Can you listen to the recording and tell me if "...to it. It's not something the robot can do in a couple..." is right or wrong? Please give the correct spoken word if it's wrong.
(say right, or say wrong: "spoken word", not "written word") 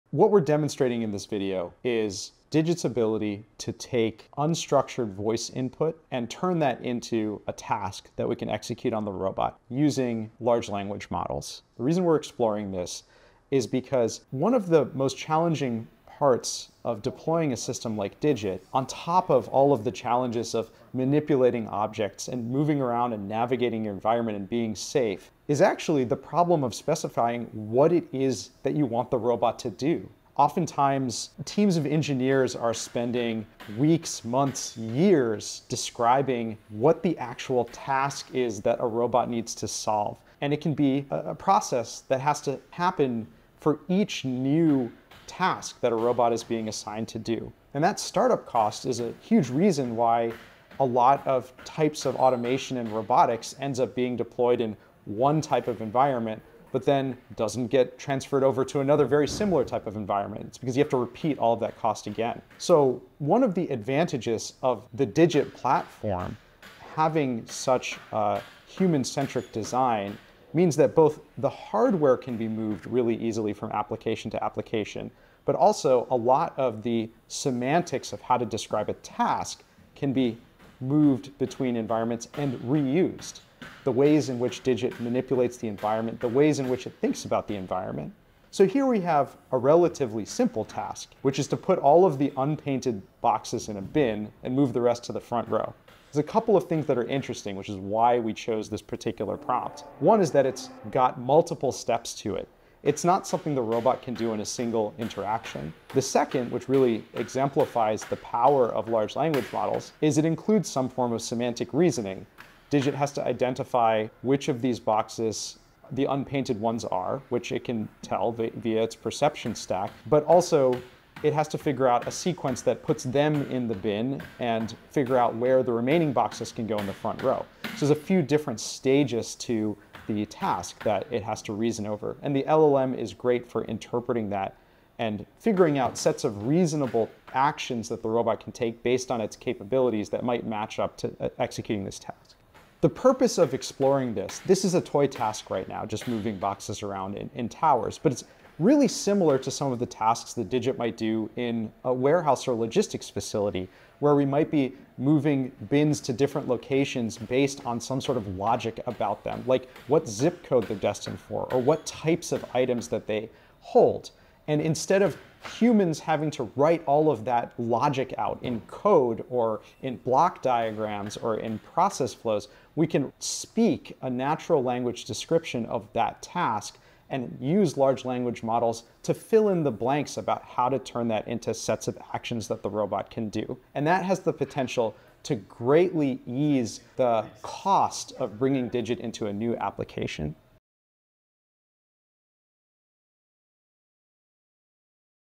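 wrong: "single", not "couple".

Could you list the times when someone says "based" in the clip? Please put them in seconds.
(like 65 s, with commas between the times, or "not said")
138 s, 157 s.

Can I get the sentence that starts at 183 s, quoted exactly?
And that has the potential to greatly ease the cost of bringing Digit into a new application.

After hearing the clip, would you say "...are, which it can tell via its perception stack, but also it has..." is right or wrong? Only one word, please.
right.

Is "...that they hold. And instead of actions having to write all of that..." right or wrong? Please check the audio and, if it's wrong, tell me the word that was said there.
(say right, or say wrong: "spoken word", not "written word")
wrong: "humans", not "actions".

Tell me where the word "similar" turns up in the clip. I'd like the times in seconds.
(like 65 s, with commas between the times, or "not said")
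59 s, 148 s.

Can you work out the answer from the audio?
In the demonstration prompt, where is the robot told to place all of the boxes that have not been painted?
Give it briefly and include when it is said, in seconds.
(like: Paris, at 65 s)
In a bin, at 93 s.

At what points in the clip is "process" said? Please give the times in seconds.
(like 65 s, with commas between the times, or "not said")
41 s, 171 s.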